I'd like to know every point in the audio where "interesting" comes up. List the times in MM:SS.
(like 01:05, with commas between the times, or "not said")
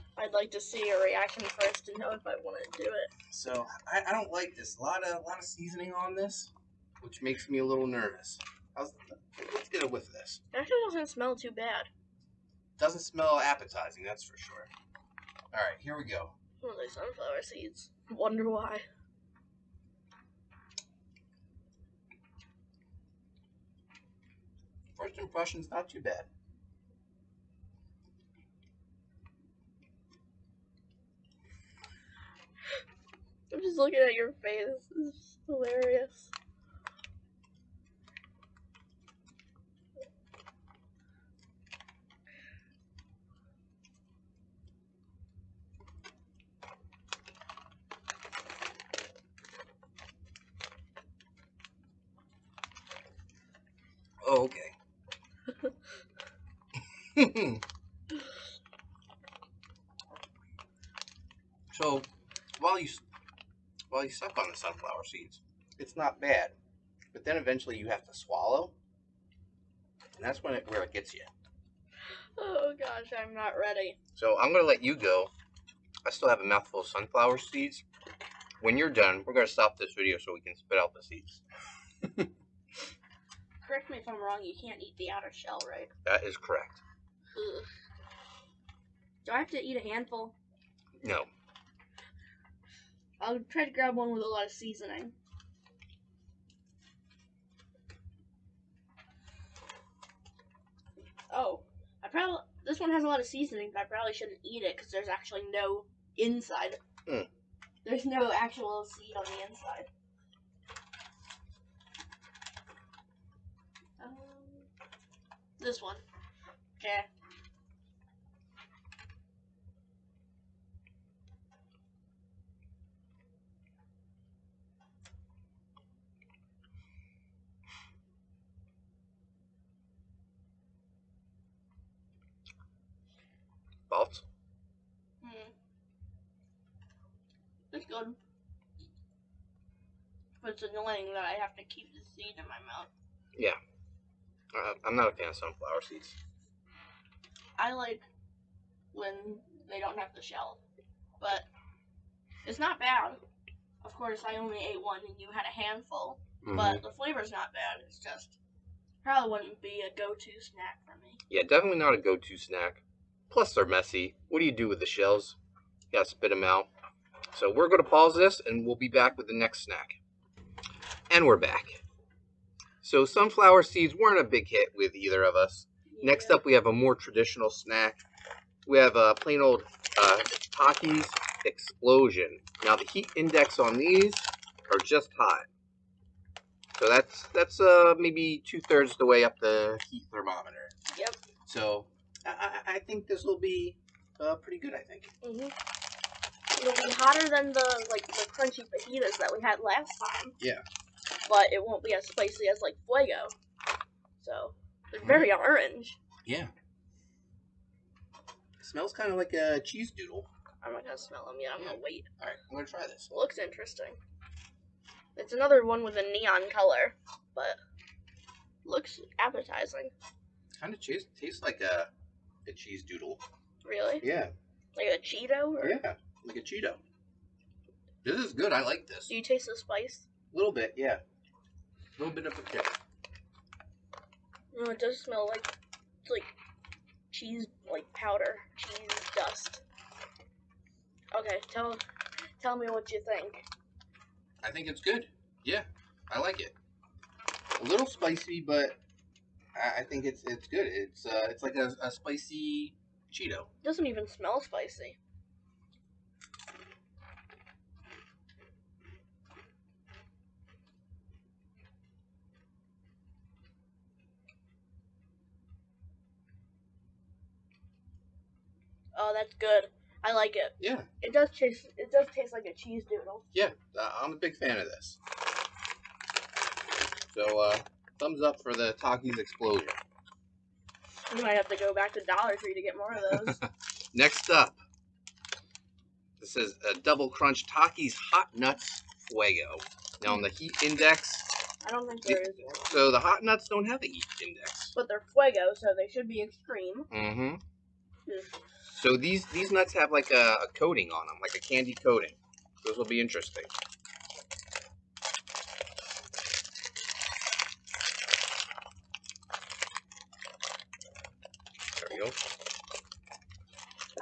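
03:33, 05:03.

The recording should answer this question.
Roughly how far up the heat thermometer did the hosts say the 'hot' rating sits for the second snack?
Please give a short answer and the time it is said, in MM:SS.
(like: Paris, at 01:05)
two thirds, at 03:08.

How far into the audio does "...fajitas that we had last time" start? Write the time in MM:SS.
03:18.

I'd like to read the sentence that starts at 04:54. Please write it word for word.
But they're fuego, so they should be extreme.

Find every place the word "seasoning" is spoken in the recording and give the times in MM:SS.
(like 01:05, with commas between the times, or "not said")
00:05, 01:34, 01:43.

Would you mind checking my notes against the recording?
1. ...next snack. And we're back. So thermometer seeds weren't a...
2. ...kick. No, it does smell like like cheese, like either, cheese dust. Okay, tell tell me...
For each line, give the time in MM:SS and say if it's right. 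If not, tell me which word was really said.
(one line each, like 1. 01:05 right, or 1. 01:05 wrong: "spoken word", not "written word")
1. 02:49 wrong: "sunflower", not "thermometer"
2. 03:52 wrong: "powder", not "either".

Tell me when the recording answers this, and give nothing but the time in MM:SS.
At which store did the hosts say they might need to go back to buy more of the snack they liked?
04:42.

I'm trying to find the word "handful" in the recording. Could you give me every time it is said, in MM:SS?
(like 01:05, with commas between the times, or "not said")
01:29, 02:35.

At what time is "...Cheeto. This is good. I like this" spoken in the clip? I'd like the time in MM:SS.
03:46.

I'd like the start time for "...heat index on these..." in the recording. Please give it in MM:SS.
03:02.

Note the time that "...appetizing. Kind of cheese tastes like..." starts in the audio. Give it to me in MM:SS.
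03:39.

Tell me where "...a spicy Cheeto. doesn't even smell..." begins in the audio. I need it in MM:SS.
04:11.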